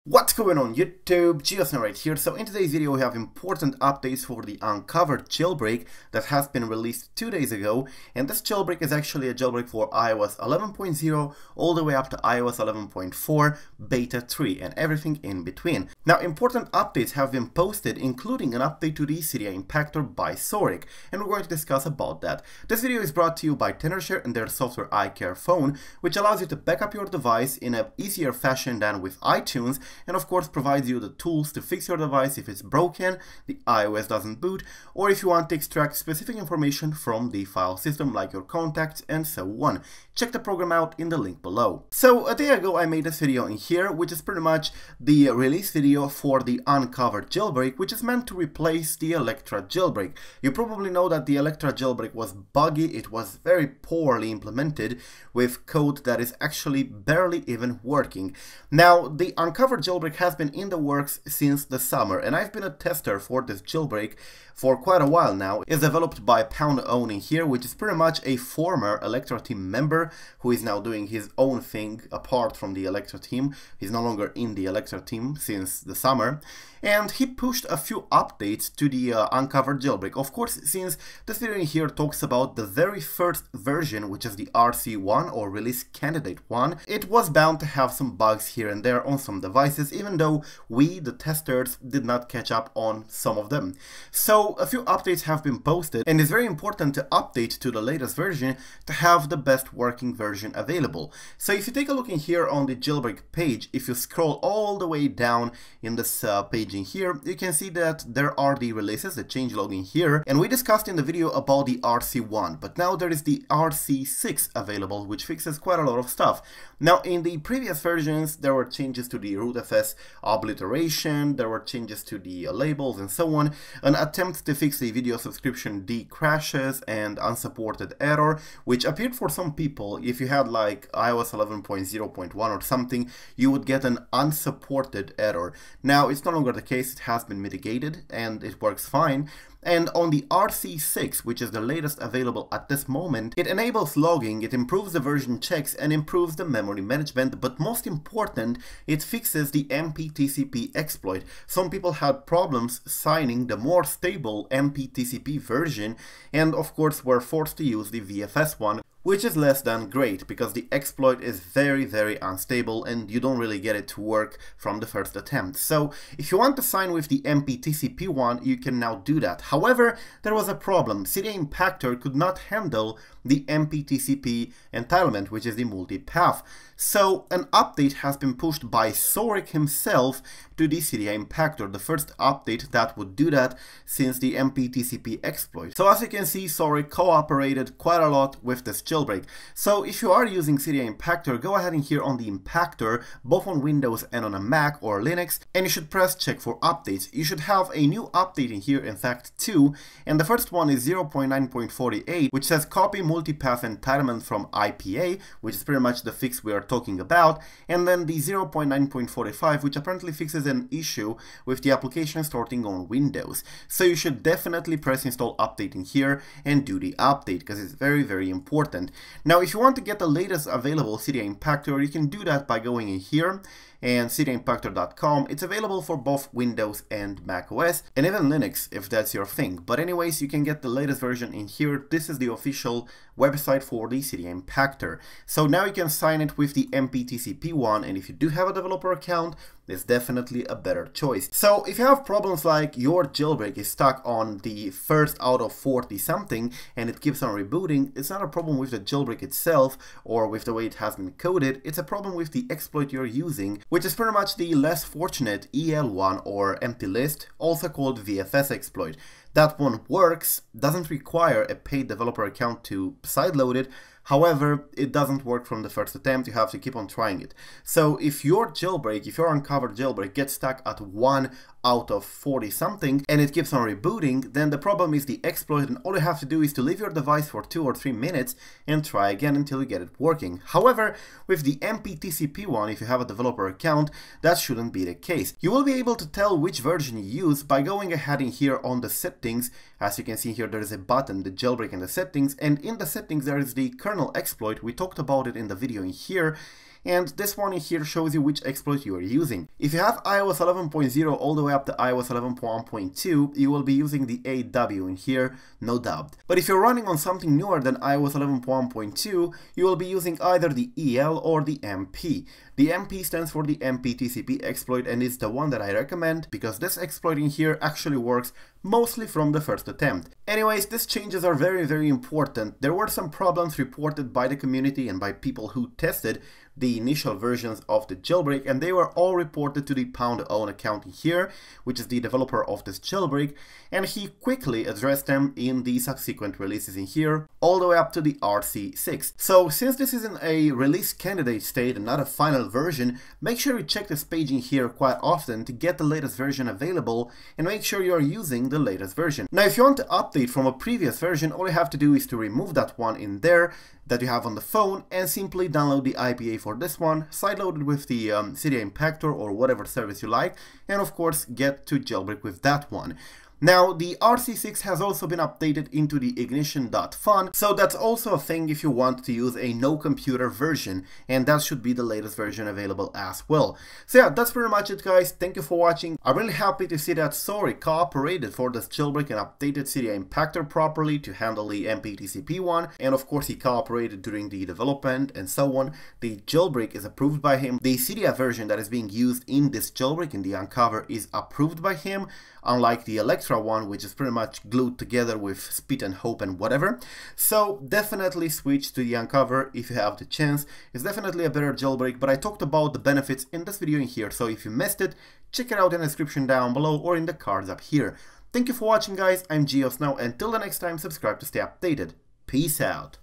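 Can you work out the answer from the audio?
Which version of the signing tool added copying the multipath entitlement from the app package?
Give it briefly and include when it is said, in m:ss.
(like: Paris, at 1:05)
0.9.48, at 3:20.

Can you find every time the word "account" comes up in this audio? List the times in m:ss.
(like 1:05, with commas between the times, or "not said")
3:58, 4:22, 4:43, 5:30.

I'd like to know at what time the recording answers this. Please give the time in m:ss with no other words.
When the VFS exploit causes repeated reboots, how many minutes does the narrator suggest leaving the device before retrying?
4:37.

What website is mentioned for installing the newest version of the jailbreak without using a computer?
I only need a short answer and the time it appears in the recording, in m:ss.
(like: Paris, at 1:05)
ignition.fun, at 6:06.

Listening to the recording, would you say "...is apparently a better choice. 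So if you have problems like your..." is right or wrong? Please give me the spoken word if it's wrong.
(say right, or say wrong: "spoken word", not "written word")
wrong: "definitely", not "apparently".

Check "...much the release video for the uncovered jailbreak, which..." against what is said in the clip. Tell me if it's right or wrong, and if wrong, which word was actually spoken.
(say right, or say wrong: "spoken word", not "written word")
right.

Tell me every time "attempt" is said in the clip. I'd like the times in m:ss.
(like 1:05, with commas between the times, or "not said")
2:03, 2:45, 4:25, 5:19.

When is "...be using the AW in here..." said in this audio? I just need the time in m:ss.
5:03.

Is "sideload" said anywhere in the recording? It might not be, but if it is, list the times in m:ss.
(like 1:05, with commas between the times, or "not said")
4:23, 5:57.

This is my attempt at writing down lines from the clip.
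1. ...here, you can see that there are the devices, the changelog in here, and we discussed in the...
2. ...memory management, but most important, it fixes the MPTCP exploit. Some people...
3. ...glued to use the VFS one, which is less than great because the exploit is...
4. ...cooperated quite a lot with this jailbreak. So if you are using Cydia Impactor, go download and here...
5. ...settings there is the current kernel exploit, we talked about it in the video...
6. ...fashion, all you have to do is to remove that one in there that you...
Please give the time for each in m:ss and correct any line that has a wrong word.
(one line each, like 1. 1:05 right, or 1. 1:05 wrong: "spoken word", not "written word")
1. 1:46 wrong: "releases", not "devices"
2. 2:26 right
3. 2:37 wrong: "forced", not "glued"
4. 3:06 wrong: "ahead", not "download"
5. 4:52 right
6. 5:50 wrong: "version", not "fashion".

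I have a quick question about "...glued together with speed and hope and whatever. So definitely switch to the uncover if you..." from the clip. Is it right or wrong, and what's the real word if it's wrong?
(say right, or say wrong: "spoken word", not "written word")
right.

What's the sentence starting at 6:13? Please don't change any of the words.
So yeah, that's pretty much it guys, thank you for watching.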